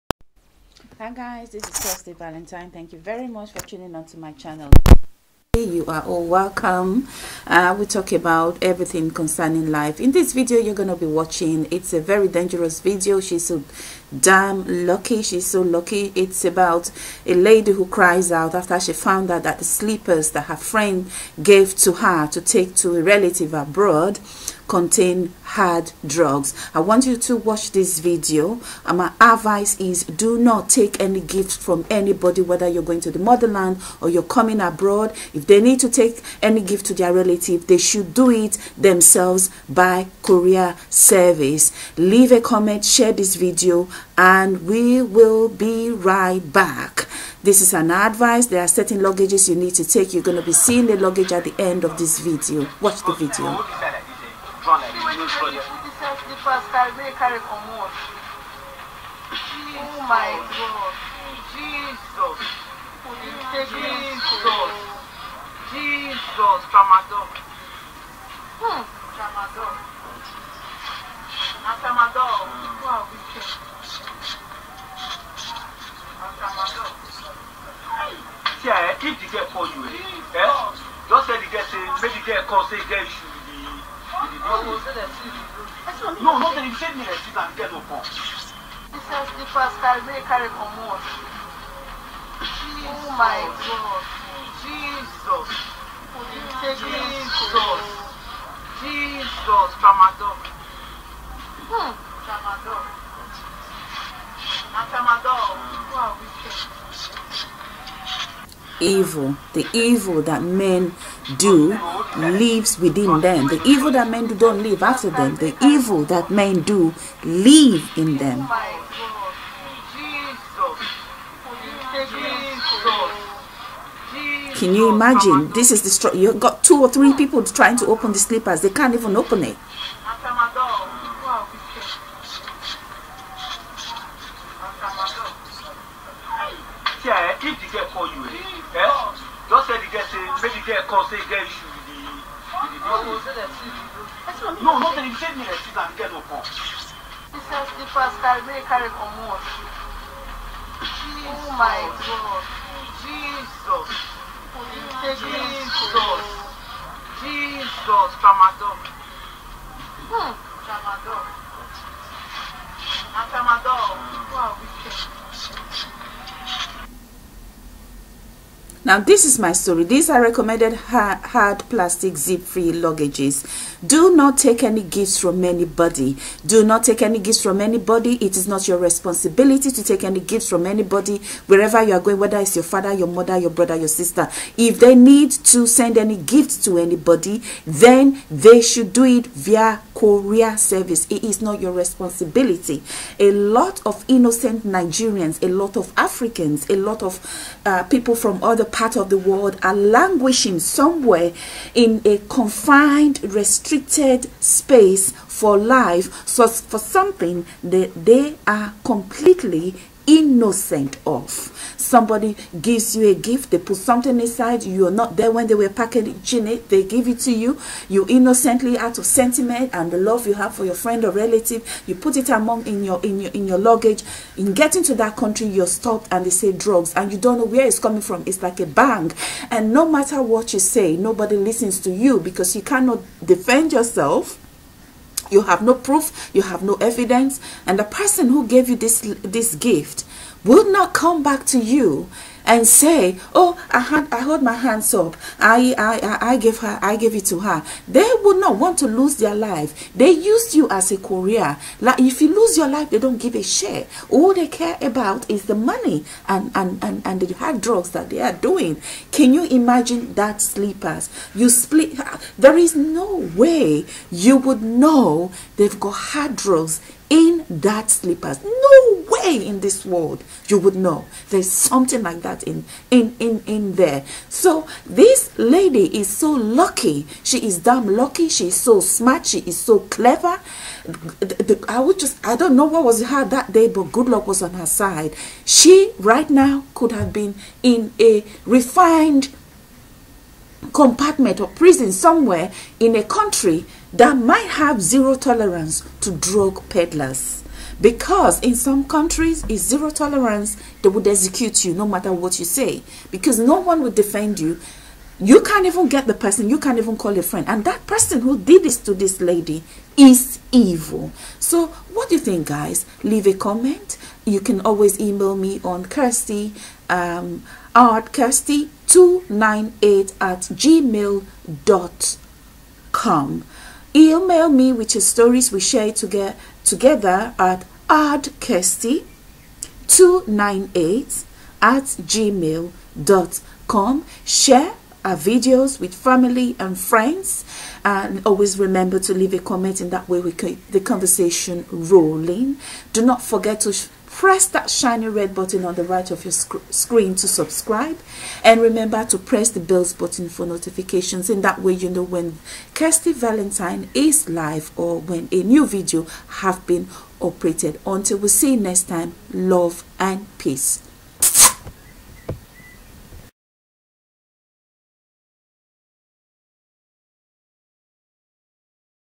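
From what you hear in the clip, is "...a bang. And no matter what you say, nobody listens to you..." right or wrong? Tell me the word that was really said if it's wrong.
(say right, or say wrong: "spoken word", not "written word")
right.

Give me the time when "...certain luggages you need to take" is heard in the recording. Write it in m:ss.
0:48.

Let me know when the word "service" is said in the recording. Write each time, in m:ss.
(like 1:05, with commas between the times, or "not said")
0:40, 3:10.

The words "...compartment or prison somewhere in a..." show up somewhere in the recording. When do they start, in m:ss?
4:50.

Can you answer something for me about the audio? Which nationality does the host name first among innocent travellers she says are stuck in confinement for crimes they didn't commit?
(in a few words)
Nigerians.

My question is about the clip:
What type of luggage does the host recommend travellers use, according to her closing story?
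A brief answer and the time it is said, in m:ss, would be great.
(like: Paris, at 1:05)
Hard plastic zip-free luggages, at 2:50.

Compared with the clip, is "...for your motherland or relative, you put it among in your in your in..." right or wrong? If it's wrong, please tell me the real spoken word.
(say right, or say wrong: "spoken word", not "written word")
wrong: "friend", not "motherland".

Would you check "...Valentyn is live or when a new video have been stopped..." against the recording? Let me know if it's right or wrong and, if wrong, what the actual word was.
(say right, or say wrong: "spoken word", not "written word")
wrong: "operated", not "stopped".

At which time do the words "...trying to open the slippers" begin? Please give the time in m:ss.
2:07.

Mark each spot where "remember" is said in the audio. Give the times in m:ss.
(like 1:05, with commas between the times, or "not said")
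5:38, 5:48.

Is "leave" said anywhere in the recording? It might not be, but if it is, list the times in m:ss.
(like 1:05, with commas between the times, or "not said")
0:41, 5:13, 5:39.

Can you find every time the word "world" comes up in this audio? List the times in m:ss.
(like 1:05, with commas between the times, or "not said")
3:19, 4:29.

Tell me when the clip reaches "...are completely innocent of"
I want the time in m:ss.
3:28.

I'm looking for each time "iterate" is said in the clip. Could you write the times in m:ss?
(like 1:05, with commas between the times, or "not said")
not said.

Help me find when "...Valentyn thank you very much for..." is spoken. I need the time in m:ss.
0:02.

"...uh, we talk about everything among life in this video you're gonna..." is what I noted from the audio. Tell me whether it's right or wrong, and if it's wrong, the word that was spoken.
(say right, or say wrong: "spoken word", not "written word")
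wrong: "concerning", not "among".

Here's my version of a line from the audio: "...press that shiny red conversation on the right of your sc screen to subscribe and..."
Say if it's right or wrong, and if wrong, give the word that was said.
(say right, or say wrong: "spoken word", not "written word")
wrong: "button", not "conversation".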